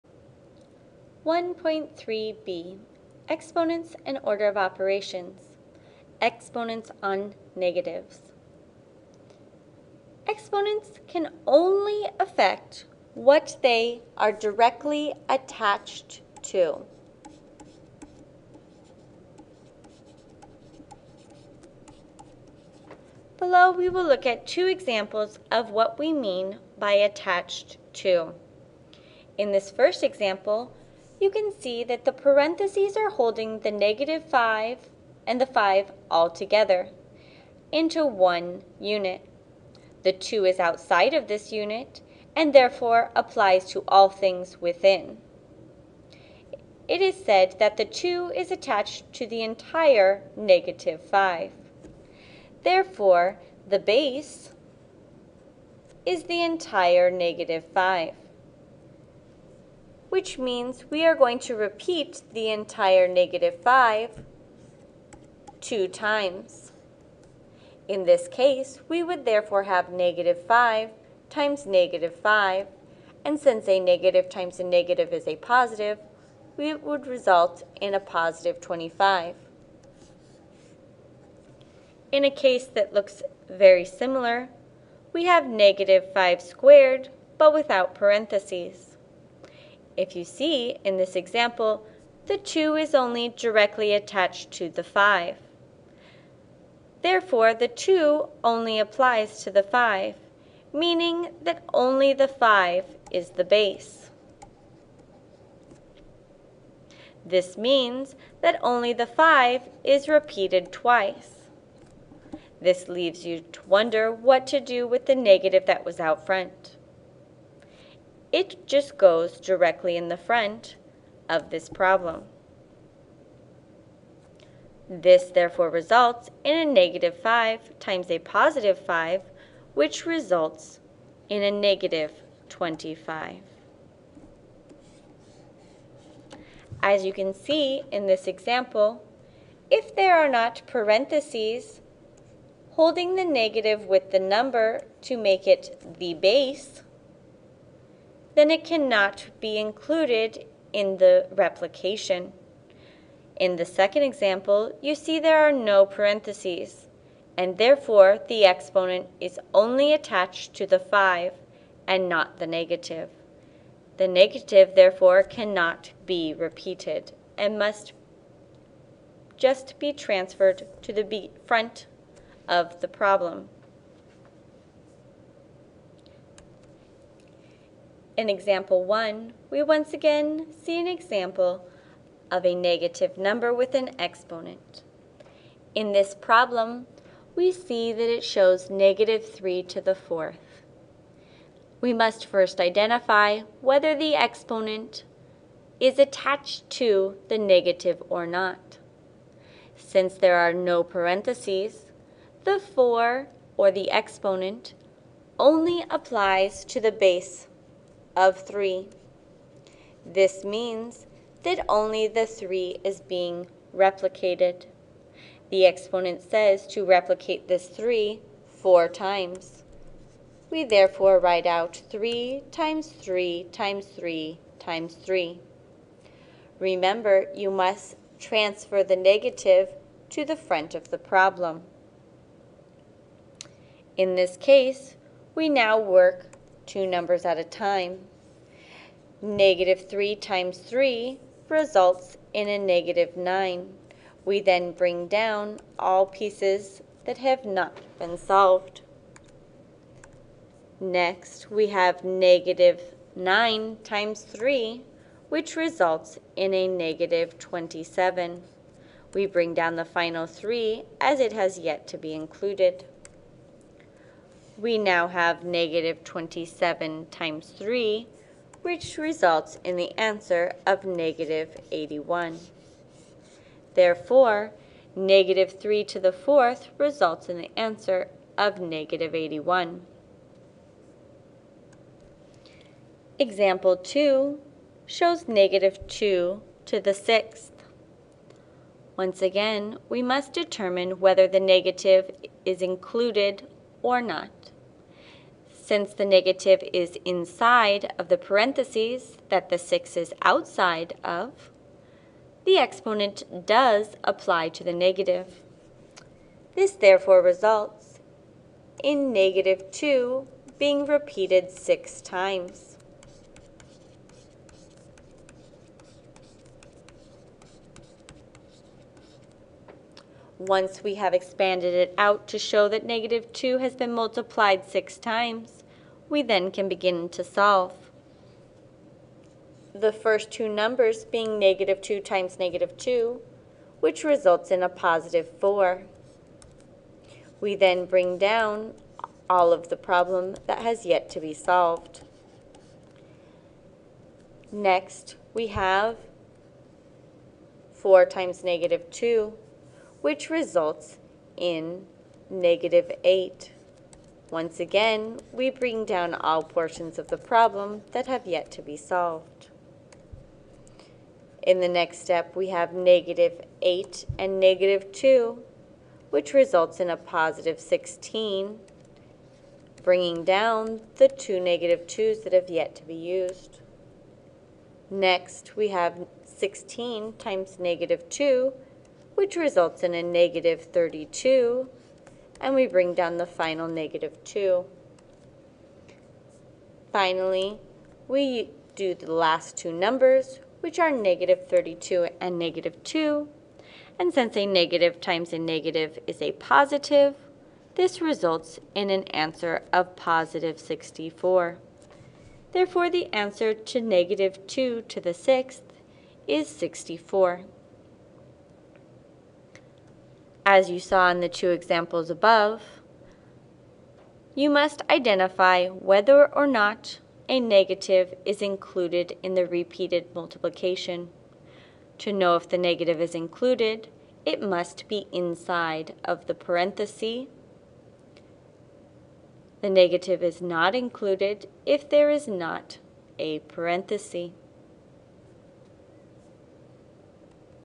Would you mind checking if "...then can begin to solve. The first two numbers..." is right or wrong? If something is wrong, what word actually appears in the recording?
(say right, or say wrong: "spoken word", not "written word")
right.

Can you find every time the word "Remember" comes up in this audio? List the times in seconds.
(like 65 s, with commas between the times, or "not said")
226 s.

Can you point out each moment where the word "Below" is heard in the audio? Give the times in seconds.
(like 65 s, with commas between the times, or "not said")
23 s.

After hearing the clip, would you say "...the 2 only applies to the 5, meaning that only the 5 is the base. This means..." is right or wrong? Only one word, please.
right.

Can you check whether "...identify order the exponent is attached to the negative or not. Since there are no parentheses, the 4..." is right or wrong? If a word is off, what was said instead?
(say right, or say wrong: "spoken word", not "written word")
wrong: "whether", not "order".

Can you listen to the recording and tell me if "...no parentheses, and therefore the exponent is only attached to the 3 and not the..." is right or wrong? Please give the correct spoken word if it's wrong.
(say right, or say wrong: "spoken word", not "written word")
wrong: "5", not "3".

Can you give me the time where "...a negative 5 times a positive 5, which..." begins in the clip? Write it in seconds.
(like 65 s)
126 s.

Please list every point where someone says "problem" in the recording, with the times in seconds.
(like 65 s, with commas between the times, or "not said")
121 s, 172 s, 186 s, 230 s, 339 s, 357 s.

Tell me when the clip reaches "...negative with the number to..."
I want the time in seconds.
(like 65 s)
143 s.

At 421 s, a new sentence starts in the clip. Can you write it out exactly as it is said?
To know if the negative is included, it must be inside of the parenthesis.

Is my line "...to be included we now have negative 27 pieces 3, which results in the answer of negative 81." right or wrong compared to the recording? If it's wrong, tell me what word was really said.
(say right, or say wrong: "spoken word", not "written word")
wrong: "times", not "pieces".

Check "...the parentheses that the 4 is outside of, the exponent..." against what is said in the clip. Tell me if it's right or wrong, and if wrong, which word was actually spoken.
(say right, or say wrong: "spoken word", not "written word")
wrong: "6", not "4".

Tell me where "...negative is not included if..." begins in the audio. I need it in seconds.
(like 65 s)
429 s.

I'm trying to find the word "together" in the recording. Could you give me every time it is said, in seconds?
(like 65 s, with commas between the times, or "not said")
36 s.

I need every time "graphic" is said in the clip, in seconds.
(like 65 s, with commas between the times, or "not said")
not said.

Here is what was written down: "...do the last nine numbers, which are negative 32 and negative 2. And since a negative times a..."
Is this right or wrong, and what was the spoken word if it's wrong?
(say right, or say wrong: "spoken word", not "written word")
wrong: "two", not "nine".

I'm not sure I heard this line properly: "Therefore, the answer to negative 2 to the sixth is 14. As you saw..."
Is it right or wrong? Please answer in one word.
wrong.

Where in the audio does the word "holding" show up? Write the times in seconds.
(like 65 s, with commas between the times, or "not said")
33 s, 142 s.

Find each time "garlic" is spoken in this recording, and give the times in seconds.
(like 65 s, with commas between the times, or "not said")
not said.